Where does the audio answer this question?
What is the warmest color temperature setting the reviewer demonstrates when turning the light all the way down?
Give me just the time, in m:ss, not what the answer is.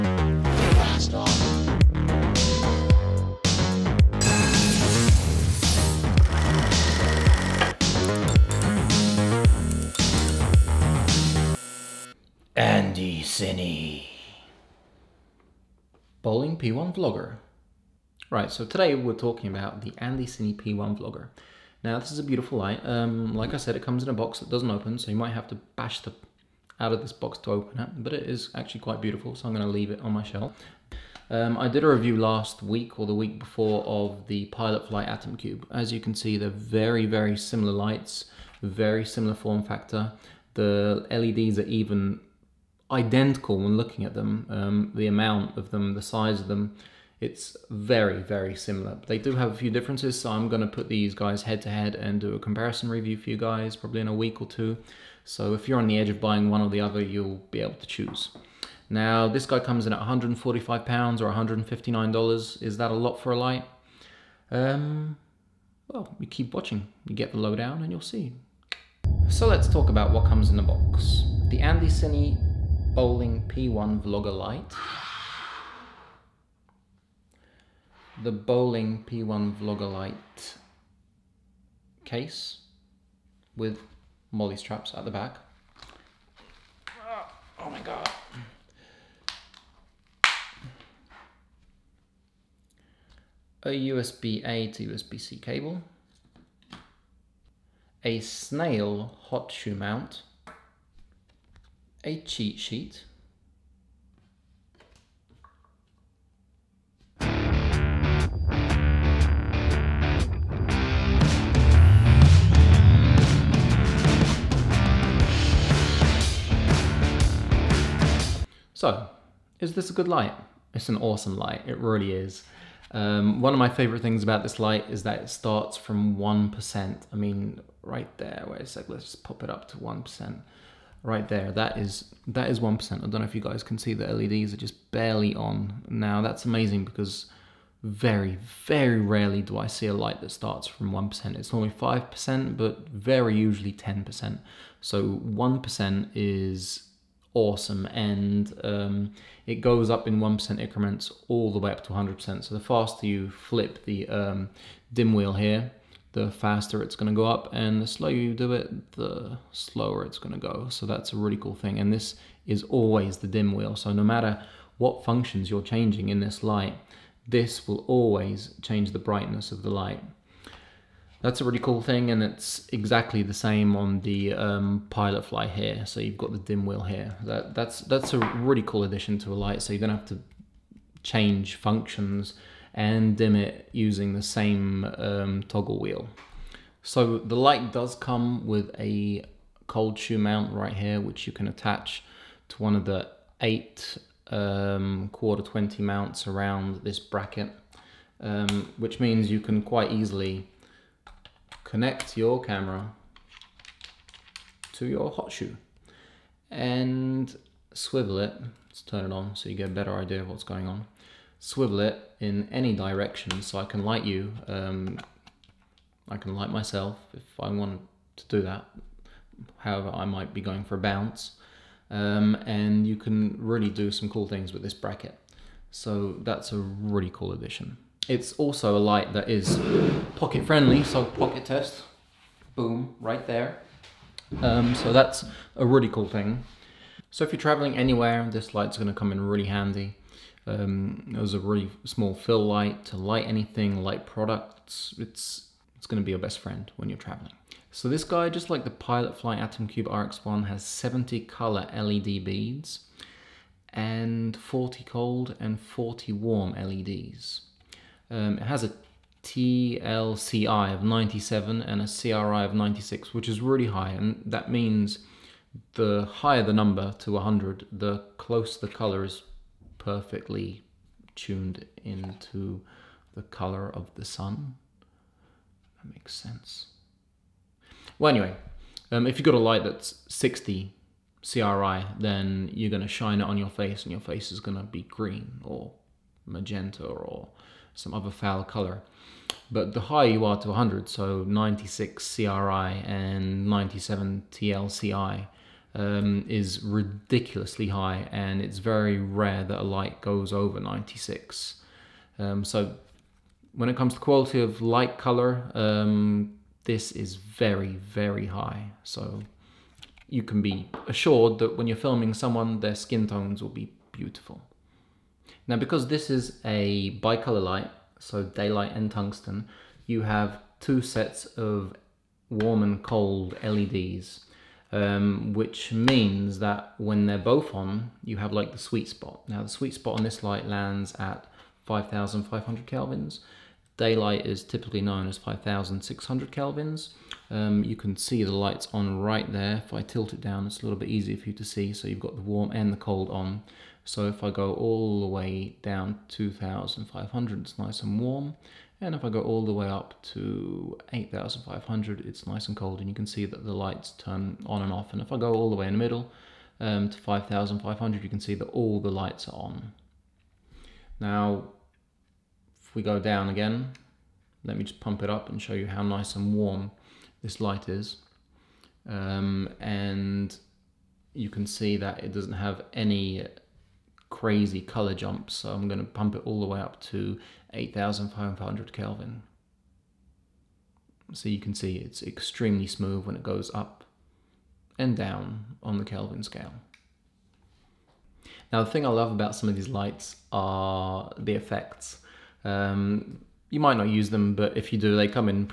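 5:46.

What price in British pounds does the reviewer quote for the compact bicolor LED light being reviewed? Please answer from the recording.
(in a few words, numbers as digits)
145 pounds.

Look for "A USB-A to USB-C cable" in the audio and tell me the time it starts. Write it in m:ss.
1:33.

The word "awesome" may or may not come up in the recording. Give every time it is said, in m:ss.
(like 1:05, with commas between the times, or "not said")
2:00, 2:27.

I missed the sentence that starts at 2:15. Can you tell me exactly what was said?
Now that's amazing because very, very rarely do I see a light that starts from 1%.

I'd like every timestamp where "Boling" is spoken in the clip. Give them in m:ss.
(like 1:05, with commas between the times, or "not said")
0:16, 1:12, 1:18.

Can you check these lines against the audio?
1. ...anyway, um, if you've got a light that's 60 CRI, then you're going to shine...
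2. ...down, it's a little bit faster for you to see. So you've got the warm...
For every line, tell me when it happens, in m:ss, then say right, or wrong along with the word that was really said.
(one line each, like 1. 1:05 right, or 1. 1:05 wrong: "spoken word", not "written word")
1. 4:38 right
2. 5:40 wrong: "easier", not "faster".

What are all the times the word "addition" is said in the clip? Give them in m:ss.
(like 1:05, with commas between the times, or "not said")
2:58, 3:47.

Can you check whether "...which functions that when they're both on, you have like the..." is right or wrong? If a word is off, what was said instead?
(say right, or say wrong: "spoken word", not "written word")
wrong: "means", not "functions".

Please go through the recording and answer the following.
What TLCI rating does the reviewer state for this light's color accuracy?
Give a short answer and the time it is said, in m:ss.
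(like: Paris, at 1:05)
97, at 4:19.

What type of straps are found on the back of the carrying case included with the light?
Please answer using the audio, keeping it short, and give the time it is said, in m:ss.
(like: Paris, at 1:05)
MOLLE straps, at 1:24.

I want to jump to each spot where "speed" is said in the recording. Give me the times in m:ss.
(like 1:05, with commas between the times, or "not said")
not said.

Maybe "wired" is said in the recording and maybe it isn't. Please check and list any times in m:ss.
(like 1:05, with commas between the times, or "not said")
not said.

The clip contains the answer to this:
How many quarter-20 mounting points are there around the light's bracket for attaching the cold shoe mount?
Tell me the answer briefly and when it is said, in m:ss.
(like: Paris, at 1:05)
8, at 3:13.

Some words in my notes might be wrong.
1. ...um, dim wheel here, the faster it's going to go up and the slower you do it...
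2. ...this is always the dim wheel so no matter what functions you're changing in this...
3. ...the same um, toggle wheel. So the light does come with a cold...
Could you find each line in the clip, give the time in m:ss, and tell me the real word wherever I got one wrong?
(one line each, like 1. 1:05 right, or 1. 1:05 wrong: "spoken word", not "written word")
1. 2:34 right
2. 2:41 right
3. 3:04 right.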